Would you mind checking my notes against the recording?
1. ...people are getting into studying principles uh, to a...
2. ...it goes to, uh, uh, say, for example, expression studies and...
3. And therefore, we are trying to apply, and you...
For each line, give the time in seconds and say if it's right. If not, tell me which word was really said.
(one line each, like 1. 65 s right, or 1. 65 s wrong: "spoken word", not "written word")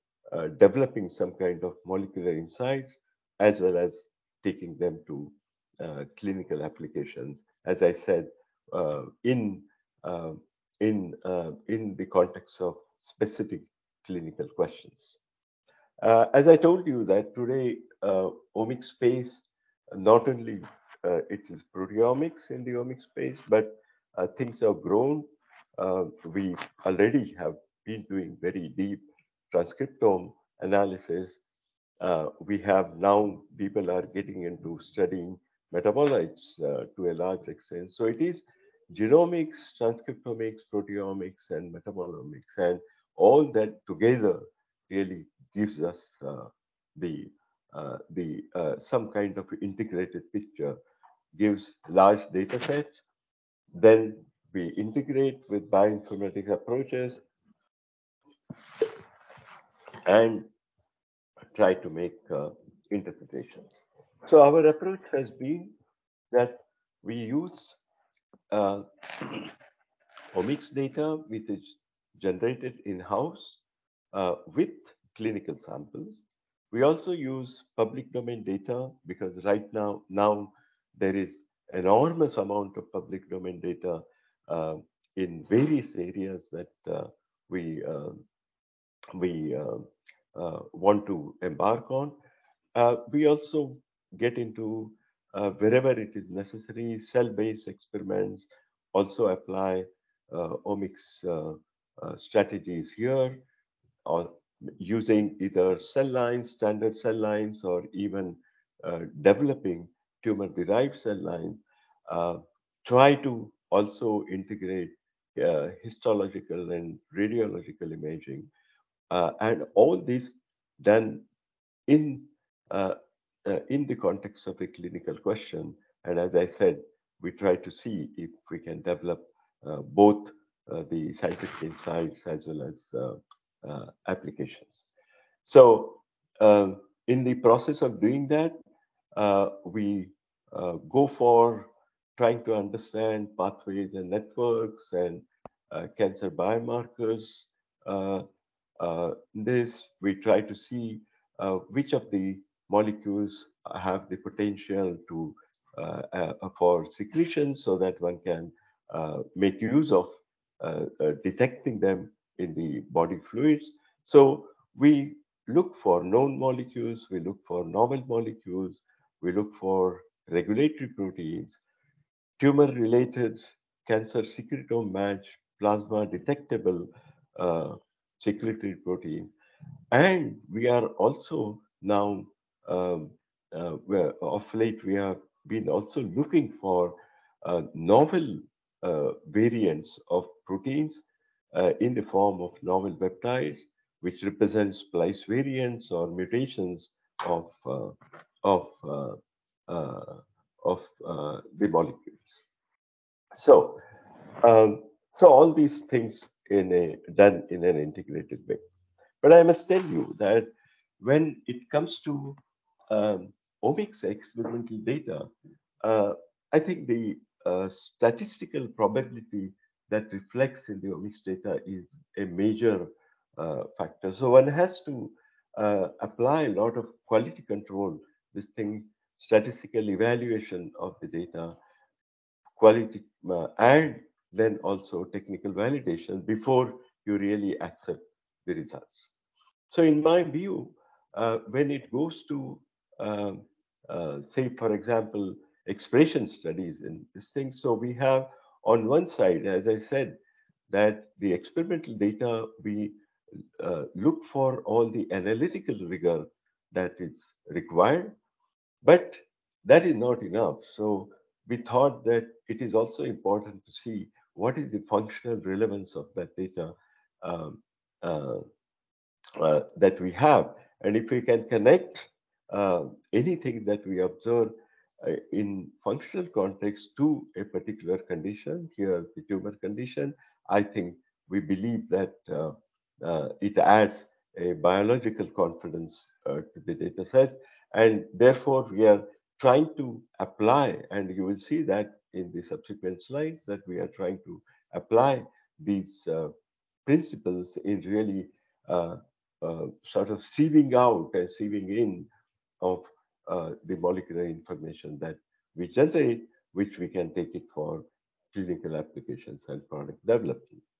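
1. 33 s wrong: "metabolites", not "principles"
2. 241 s right
3. 287 s right.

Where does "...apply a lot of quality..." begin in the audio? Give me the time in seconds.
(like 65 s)
226 s.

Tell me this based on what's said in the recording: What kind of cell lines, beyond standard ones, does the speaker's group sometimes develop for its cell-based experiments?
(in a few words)
tumor-derived cell lines.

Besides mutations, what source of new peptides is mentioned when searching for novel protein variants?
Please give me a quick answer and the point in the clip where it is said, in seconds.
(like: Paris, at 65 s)
splice variants, at 194 s.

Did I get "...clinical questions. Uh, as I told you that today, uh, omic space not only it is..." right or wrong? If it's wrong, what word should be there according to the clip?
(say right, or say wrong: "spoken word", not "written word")
right.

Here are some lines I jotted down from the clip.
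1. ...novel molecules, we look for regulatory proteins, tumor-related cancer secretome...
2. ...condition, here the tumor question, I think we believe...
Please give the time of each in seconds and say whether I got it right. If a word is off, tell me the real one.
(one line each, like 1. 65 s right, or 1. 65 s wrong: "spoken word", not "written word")
1. 167 s right
2. 277 s wrong: "condition", not "question".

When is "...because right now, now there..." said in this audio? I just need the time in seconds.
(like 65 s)
79 s.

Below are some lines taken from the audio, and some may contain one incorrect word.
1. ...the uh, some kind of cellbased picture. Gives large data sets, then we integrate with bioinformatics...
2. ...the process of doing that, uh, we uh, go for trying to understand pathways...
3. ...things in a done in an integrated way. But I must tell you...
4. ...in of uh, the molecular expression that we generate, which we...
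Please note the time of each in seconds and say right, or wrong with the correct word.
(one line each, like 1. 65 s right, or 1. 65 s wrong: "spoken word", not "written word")
1. 48 s wrong: "integrated", not "cellbased"
2. 137 s right
3. 205 s right
4. 301 s wrong: "information", not "expression".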